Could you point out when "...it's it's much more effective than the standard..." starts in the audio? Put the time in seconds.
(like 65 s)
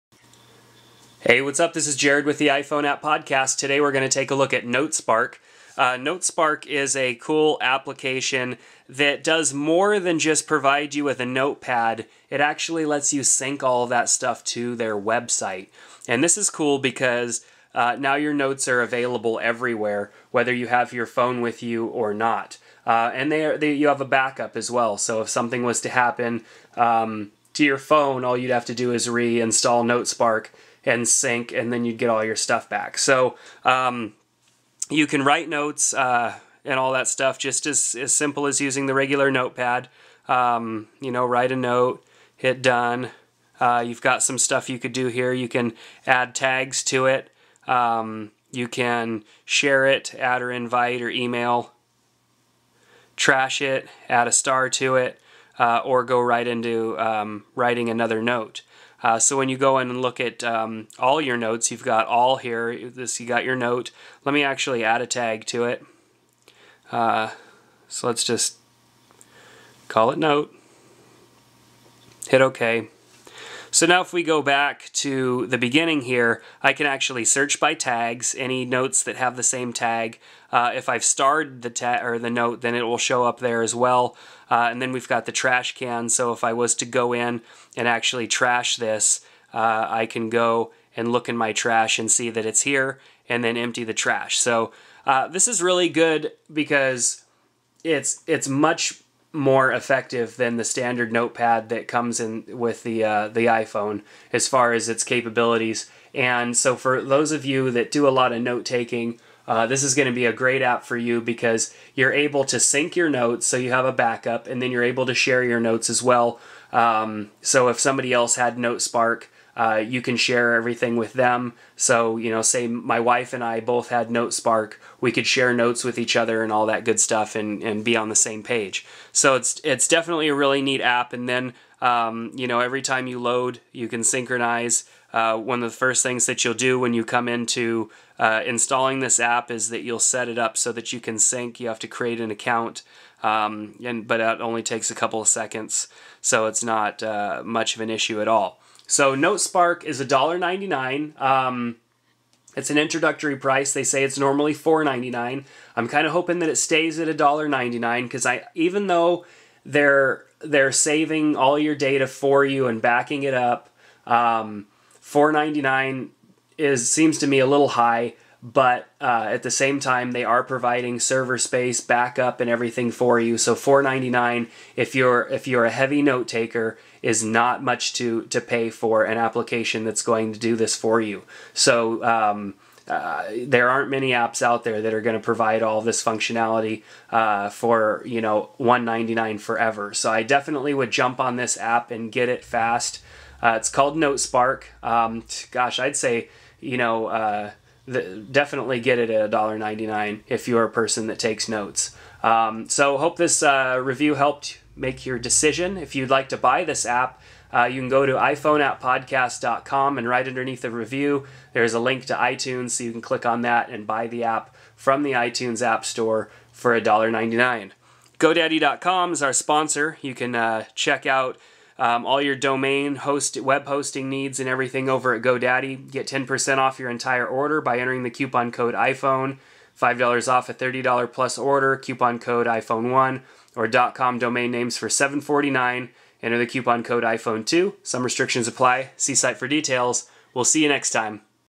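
97 s.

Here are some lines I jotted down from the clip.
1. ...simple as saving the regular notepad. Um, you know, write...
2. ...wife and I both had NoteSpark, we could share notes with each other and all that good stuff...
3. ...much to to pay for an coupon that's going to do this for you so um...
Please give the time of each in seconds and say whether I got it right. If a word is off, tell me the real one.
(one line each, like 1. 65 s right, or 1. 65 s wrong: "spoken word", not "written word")
1. 38 s wrong: "using", not "saving"
2. 122 s right
3. 177 s wrong: "application", not "coupon".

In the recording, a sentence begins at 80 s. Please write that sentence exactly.
Uh, if I've starred the tag or the note, then it will show up there as well.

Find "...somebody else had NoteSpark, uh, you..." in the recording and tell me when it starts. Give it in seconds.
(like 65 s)
117 s.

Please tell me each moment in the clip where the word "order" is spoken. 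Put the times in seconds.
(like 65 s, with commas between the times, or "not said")
227 s, 231 s.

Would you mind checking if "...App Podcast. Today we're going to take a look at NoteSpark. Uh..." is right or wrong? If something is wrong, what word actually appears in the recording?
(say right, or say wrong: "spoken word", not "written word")
right.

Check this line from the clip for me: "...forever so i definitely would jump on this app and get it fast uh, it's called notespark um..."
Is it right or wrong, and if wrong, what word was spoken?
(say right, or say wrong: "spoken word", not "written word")
right.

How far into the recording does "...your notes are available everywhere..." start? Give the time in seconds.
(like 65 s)
18 s.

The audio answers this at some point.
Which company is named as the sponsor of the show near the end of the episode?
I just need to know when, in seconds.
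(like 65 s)
218 s.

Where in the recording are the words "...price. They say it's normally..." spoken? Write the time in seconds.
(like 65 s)
153 s.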